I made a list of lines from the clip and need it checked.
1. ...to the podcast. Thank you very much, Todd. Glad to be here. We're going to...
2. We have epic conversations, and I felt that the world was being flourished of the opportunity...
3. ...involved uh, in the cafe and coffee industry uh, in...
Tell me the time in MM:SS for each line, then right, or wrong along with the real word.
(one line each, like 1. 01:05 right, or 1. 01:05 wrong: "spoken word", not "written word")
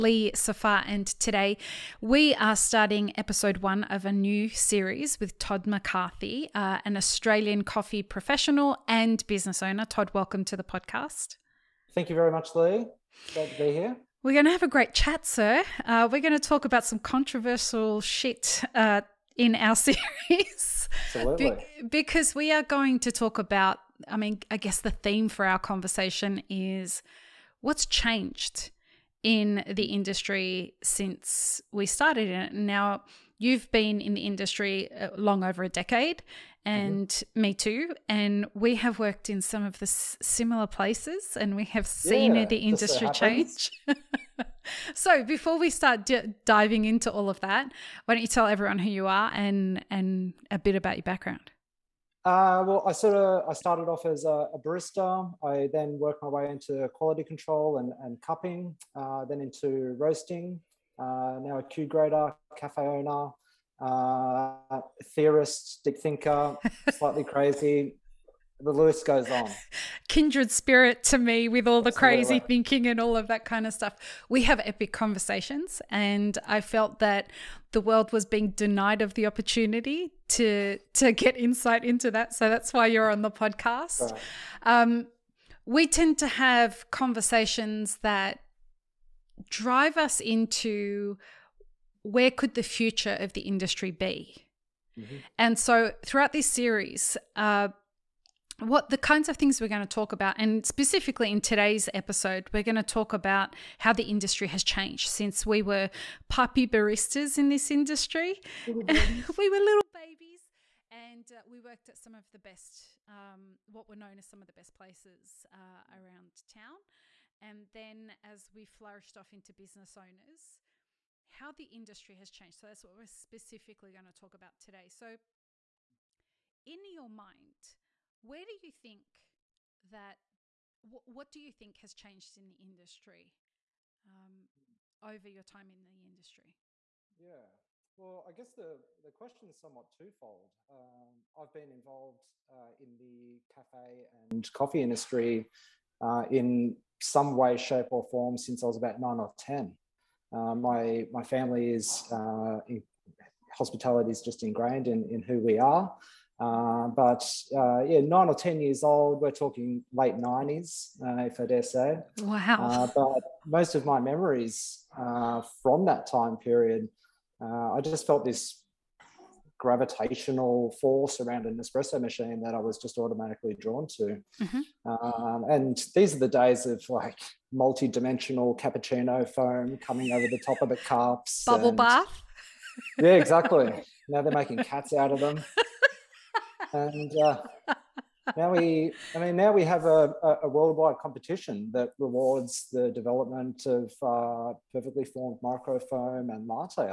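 1. 00:10 wrong: "Lee", not "Todd"
2. 01:14 wrong: "denied", not "flourished"
3. 02:21 right.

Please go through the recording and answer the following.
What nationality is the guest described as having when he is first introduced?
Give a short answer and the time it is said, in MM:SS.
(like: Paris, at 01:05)
Australian, at 00:06.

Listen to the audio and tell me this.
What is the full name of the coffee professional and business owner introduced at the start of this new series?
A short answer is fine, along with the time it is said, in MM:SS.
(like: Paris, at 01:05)
Todd McCarthy, at 00:05.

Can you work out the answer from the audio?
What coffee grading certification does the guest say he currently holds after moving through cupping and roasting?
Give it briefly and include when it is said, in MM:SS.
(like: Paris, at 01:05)
Q grader, at 01:01.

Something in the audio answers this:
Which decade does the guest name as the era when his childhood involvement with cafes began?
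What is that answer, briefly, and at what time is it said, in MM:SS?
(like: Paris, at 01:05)
late 90s, at 02:39.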